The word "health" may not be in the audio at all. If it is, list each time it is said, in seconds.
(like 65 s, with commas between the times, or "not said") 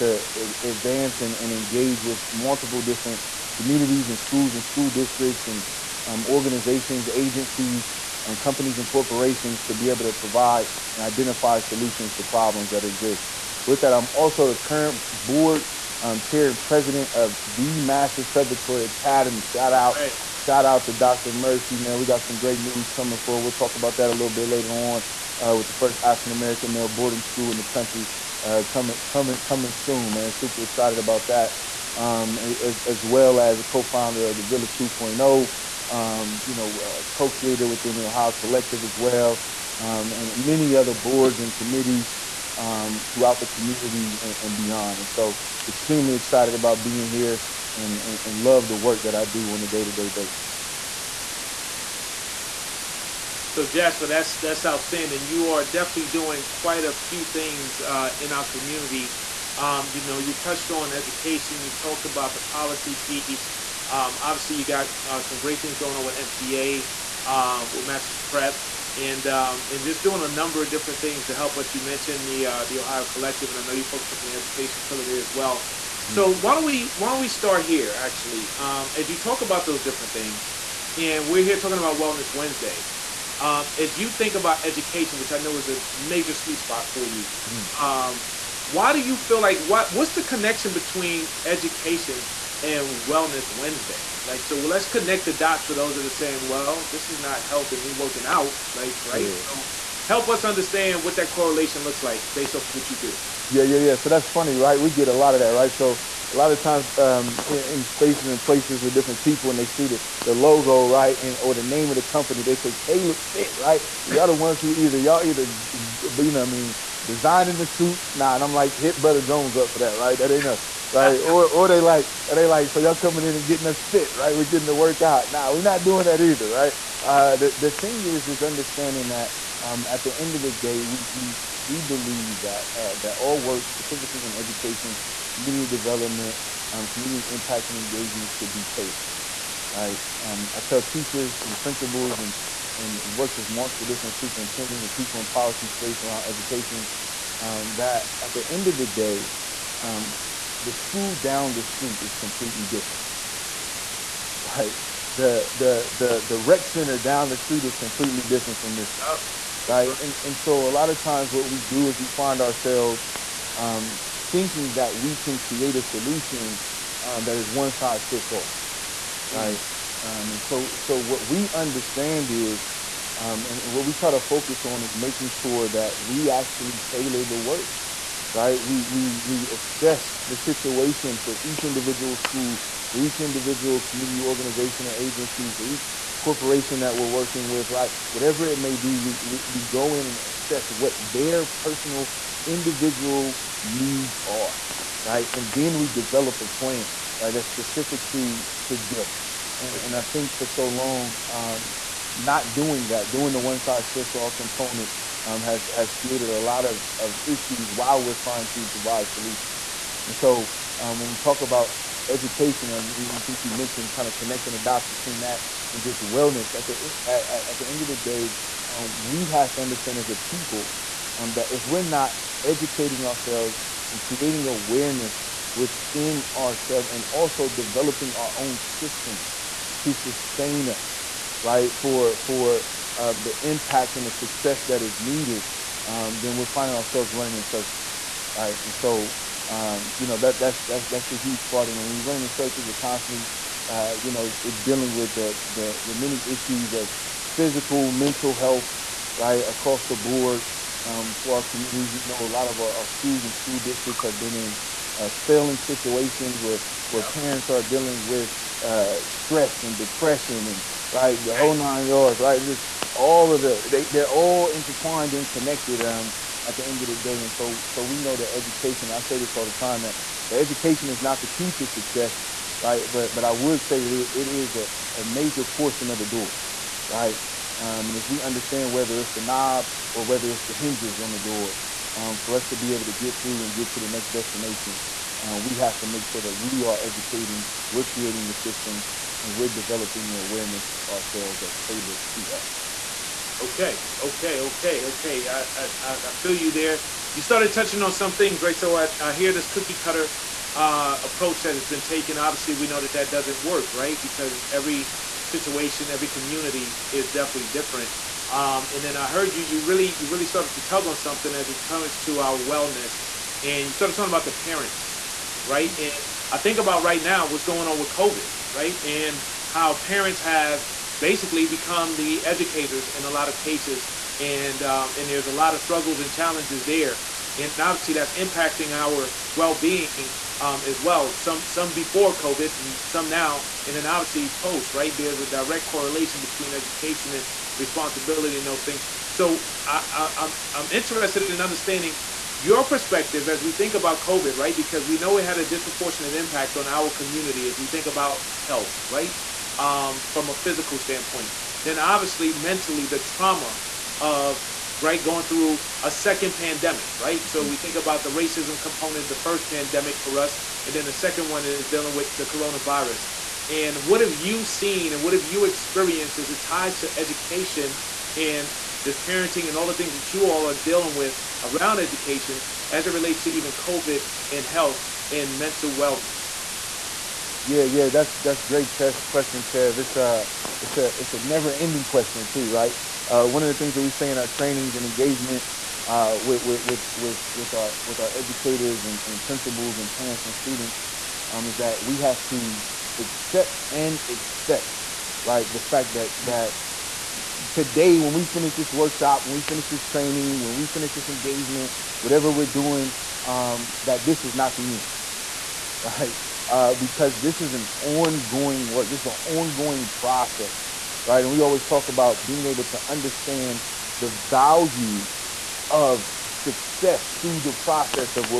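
97 s, 248 s, 348 s, 374 s.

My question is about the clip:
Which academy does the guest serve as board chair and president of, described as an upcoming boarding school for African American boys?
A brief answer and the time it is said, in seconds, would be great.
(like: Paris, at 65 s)
Masters Preparatory Academy, at 17 s.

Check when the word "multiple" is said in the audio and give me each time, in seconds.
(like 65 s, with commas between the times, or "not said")
2 s, 143 s.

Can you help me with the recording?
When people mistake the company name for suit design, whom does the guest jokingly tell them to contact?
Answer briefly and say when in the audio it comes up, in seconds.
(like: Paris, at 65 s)
Brother Jones, at 118 s.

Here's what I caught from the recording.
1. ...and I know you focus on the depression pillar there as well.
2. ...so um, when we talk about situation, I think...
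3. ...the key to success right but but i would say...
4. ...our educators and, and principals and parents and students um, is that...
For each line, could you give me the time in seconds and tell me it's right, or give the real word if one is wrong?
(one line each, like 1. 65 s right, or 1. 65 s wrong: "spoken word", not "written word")
1. 73 s wrong: "education", not "depression"
2. 210 s wrong: "education", not "situation"
3. 271 s right
4. 387 s right.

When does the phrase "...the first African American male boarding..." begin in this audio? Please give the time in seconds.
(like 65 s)
25 s.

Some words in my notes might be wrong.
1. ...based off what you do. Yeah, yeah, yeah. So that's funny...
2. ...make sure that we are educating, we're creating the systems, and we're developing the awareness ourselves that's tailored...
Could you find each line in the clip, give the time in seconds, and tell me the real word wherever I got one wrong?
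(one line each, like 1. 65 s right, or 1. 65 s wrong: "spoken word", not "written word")
1. 102 s right
2. 285 s right.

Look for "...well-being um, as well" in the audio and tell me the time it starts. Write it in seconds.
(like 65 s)
329 s.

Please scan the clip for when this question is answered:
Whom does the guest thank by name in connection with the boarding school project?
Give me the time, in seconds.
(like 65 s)
20 s.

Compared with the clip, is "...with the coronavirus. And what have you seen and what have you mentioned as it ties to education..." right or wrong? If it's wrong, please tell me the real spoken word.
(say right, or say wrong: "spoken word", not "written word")
wrong: "experienced", not "mentioned".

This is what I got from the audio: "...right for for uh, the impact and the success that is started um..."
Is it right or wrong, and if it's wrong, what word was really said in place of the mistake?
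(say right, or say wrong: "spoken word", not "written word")
wrong: "needed", not "started".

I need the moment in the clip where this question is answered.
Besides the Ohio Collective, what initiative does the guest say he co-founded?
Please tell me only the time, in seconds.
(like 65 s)
34 s.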